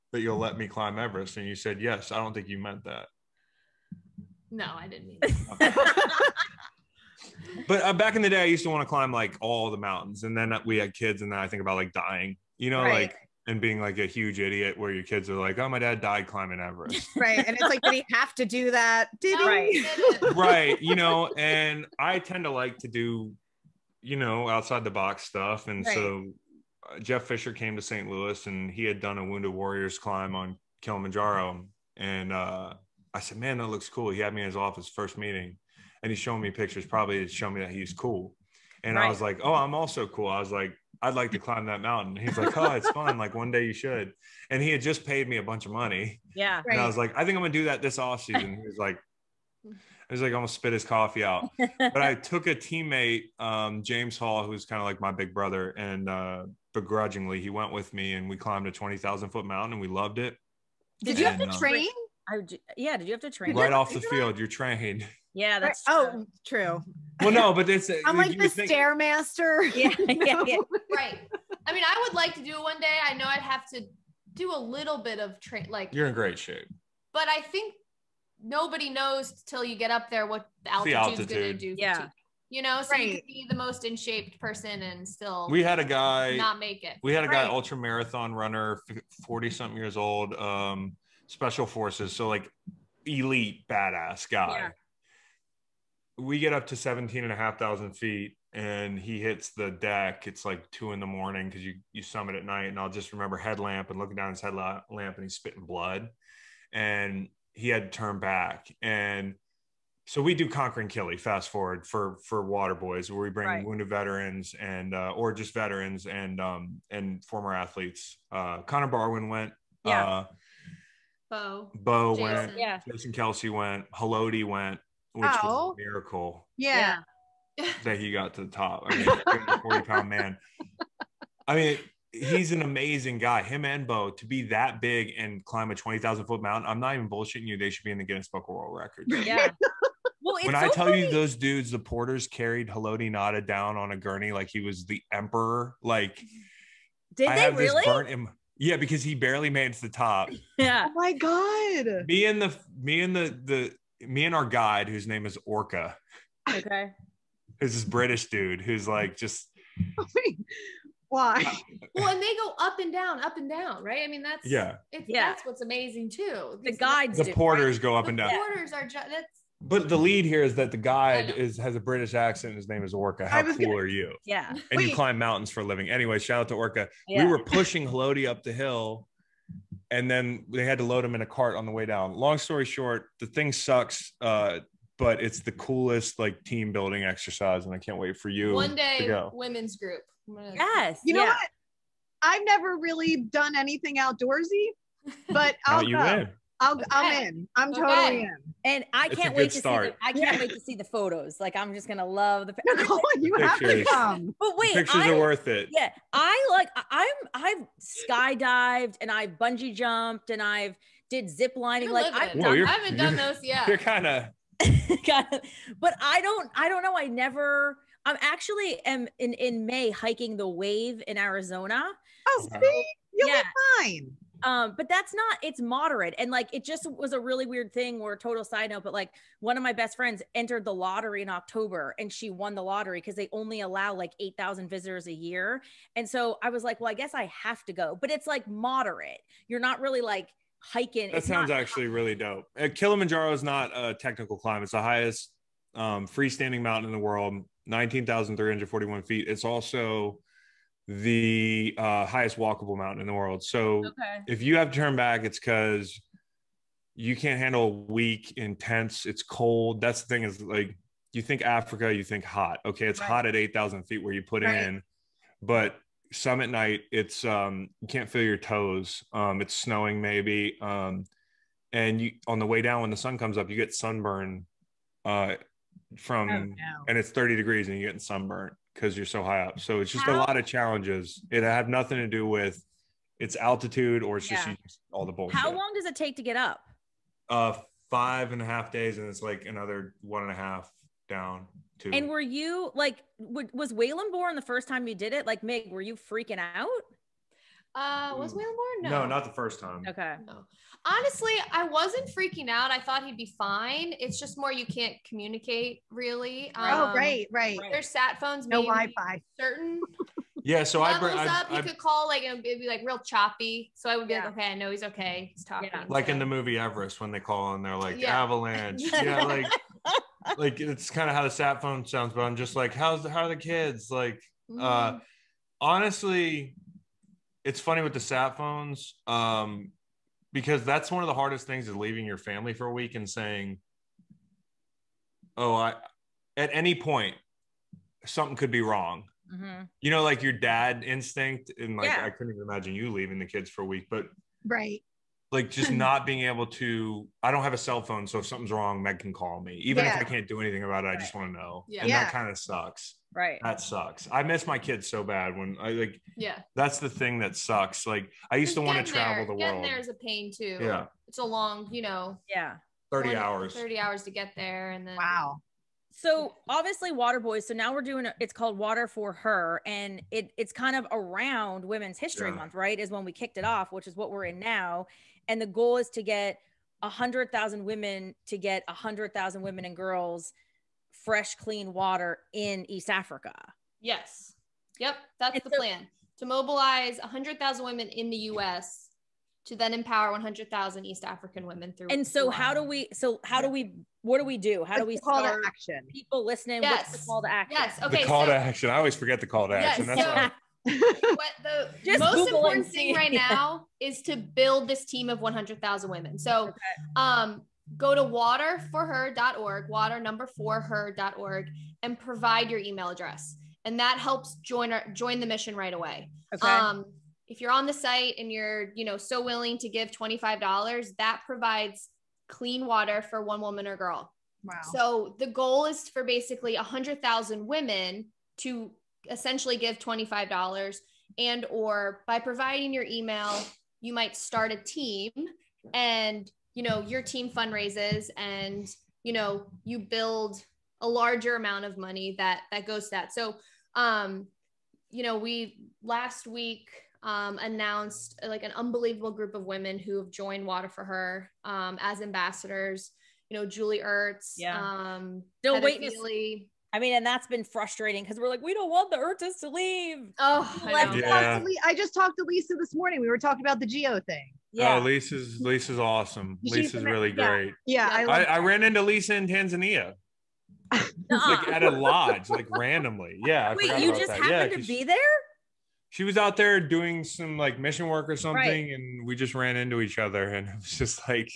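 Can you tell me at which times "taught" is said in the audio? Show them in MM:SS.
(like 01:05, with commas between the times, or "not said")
not said.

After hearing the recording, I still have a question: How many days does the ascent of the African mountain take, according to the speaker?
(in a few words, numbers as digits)
Five and a half days.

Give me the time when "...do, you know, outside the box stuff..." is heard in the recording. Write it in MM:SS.
00:22.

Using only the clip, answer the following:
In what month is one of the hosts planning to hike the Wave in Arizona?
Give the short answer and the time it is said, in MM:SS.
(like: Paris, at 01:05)
May, at 03:39.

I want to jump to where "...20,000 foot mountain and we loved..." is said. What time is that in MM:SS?
00:58.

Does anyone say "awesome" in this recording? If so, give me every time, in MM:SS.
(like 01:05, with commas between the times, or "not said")
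07:45.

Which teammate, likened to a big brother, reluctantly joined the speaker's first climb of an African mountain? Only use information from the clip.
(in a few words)
James Hall.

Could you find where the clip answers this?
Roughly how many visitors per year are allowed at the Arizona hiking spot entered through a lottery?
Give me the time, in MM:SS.
03:54.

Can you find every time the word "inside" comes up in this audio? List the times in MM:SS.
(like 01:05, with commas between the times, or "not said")
not said.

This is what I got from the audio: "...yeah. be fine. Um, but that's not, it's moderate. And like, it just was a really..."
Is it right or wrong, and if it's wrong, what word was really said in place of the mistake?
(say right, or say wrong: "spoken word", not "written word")
right.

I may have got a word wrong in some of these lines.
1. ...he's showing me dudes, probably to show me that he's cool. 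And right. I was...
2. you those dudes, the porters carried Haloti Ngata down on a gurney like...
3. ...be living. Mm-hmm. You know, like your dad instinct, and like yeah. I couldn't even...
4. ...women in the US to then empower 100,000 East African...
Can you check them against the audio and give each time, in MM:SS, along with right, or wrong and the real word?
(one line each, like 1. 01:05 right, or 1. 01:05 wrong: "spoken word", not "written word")
1. 00:36 wrong: "pictures", not "dudes"
2. 02:20 right
3. 05:38 wrong: "wrong", not "living"
4. 06:27 right.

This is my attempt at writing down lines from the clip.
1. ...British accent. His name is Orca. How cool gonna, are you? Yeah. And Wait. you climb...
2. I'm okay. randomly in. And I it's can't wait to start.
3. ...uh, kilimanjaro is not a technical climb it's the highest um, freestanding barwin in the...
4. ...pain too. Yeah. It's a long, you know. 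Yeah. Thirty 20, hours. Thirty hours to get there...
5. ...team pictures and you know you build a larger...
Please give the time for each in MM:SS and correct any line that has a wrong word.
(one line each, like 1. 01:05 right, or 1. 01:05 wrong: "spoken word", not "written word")
1. 02:51 right
2. 03:17 wrong: "totally", not "randomly"
3. 04:02 wrong: "mountain", not "barwin"
4. 05:59 right
5. 07:17 wrong: "fundraises", not "pictures".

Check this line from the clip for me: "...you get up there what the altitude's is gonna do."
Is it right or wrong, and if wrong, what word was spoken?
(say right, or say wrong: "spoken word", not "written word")
right.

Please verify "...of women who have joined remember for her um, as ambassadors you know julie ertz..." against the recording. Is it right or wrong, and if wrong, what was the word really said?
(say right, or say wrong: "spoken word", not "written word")
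wrong: "water", not "remember".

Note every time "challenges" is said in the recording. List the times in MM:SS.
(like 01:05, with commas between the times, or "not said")
04:40.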